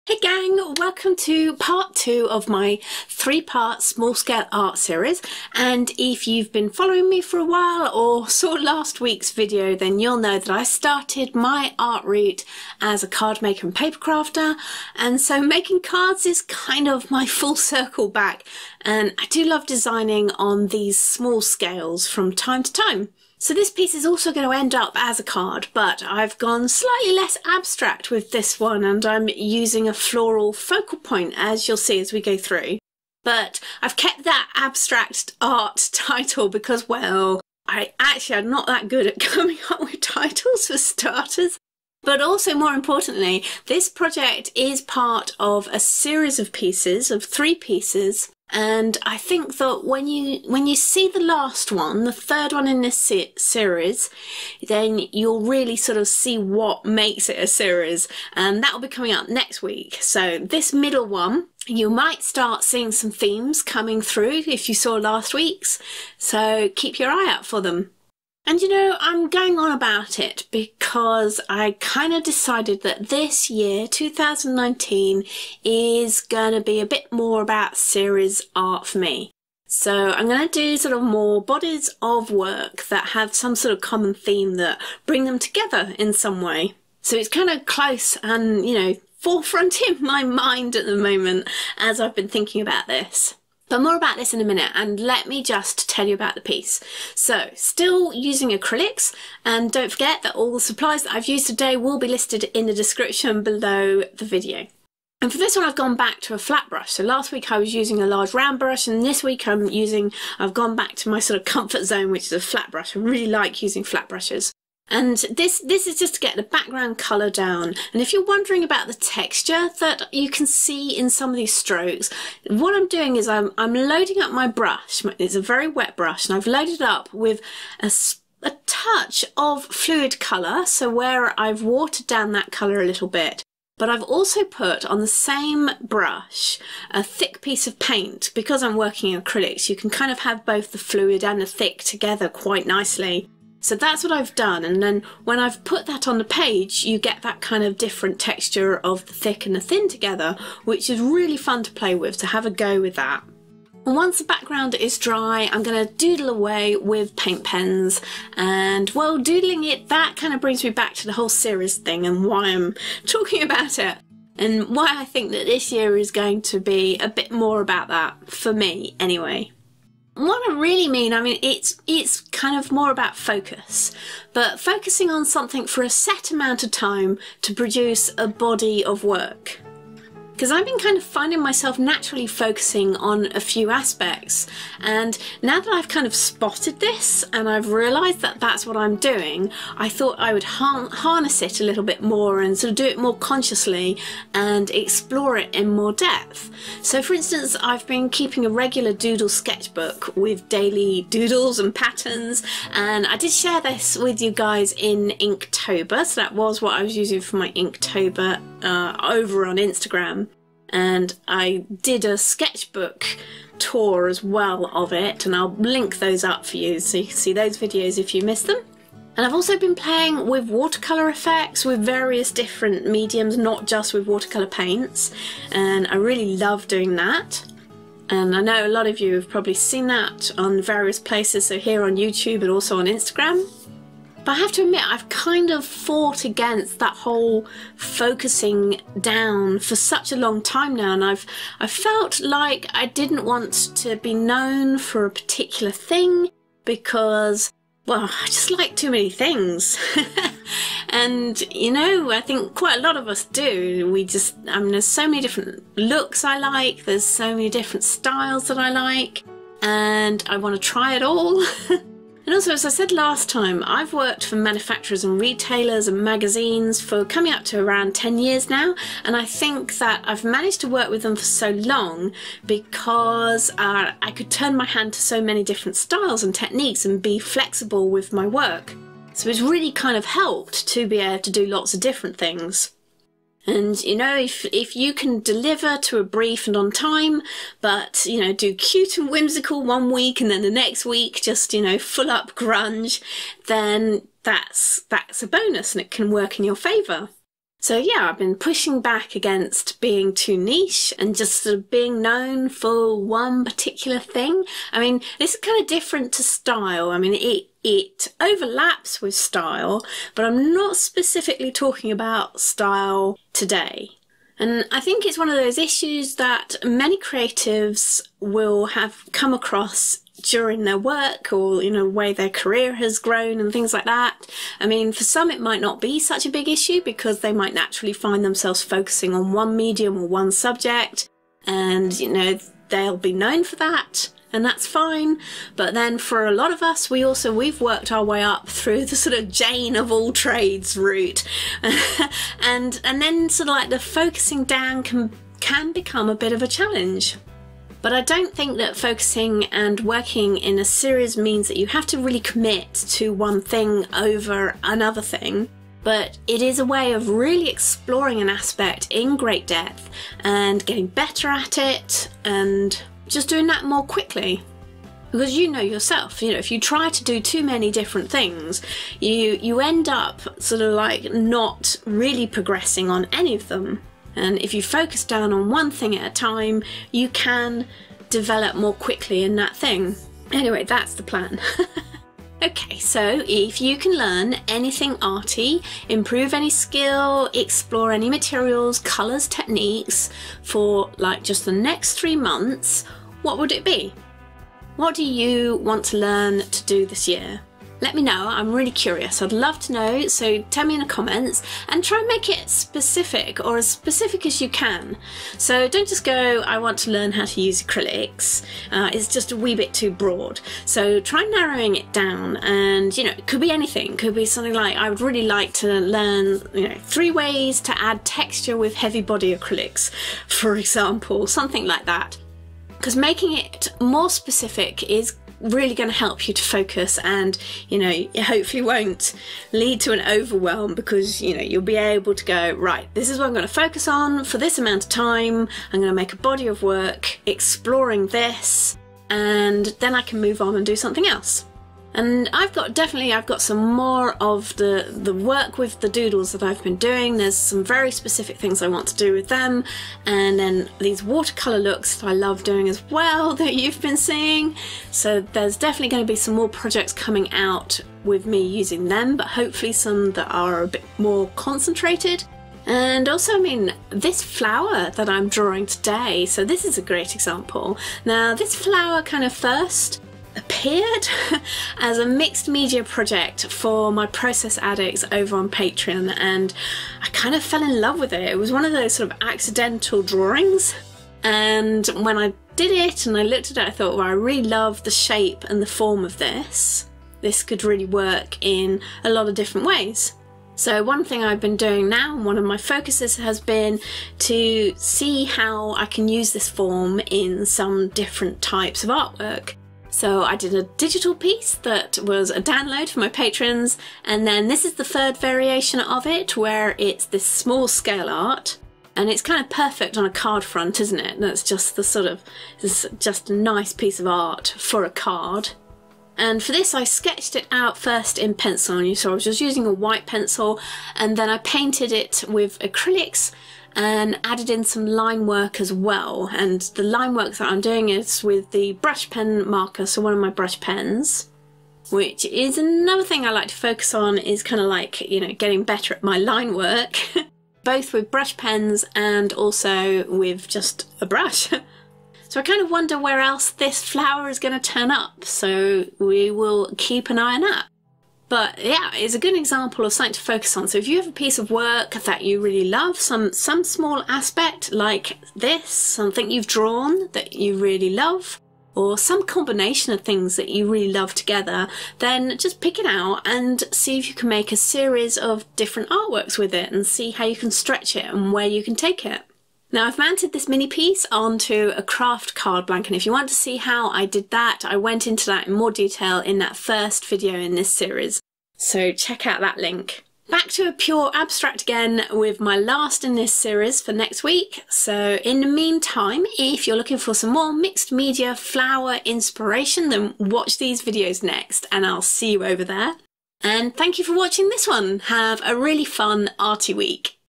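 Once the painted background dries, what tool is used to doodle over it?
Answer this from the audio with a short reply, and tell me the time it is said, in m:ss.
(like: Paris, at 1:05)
Paint pens, at 2:37.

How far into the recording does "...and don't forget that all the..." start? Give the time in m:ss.
1:39.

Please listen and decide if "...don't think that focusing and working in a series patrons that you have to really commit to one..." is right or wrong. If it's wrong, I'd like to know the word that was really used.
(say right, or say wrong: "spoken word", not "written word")
wrong: "means", not "patrons".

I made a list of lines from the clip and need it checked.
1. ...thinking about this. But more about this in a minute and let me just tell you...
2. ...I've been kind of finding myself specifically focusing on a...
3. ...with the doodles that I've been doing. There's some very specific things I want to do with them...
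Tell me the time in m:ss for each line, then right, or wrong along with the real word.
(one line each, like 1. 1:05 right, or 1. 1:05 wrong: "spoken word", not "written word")
1. 1:32 right
2. 3:00 wrong: "naturally", not "specifically"
3. 7:25 right.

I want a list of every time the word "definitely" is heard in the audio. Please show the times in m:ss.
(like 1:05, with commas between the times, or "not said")
7:22, 7:35.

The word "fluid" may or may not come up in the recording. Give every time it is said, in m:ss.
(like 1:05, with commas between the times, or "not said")
2:09, 2:20.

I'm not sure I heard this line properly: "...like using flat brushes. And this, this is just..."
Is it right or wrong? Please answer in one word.
right.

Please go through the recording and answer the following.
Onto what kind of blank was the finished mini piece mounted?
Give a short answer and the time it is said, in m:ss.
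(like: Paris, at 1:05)
Craft card blank, at 9:31.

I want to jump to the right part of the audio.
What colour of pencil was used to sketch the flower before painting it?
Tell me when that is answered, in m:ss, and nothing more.
8:39.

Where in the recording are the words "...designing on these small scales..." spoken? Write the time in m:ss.
0:19.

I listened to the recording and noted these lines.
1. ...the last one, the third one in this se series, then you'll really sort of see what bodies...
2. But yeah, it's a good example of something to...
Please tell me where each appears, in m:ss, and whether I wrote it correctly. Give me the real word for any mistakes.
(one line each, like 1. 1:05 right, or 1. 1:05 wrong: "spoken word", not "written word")
1. 0:51 wrong: "makes", not "bodies"
2. 9:08 right.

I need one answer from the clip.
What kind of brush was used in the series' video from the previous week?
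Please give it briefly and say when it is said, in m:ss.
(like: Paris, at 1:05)
Large round brush, at 1:48.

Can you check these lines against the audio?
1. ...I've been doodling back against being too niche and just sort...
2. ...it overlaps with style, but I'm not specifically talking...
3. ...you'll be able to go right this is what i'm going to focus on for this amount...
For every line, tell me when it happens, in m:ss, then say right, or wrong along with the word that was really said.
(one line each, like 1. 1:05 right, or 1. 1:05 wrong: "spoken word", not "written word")
1. 4:58 wrong: "pushing", not "doodling"
2. 5:07 right
3. 7:11 right.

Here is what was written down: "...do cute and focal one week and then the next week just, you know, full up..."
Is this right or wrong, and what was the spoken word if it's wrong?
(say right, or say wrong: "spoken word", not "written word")
wrong: "whimsical", not "focal".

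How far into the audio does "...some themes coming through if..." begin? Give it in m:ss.
1:02.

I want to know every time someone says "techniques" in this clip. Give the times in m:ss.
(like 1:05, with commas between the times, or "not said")
4:36, 6:29.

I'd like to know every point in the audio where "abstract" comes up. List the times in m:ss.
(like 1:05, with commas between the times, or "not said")
0:27, 0:34, 9:41.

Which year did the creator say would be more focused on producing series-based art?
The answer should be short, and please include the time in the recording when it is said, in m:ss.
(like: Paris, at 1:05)
2019, at 1:13.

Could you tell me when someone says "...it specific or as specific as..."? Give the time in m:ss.
6:42.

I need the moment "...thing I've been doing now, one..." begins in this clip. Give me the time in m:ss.
8:11.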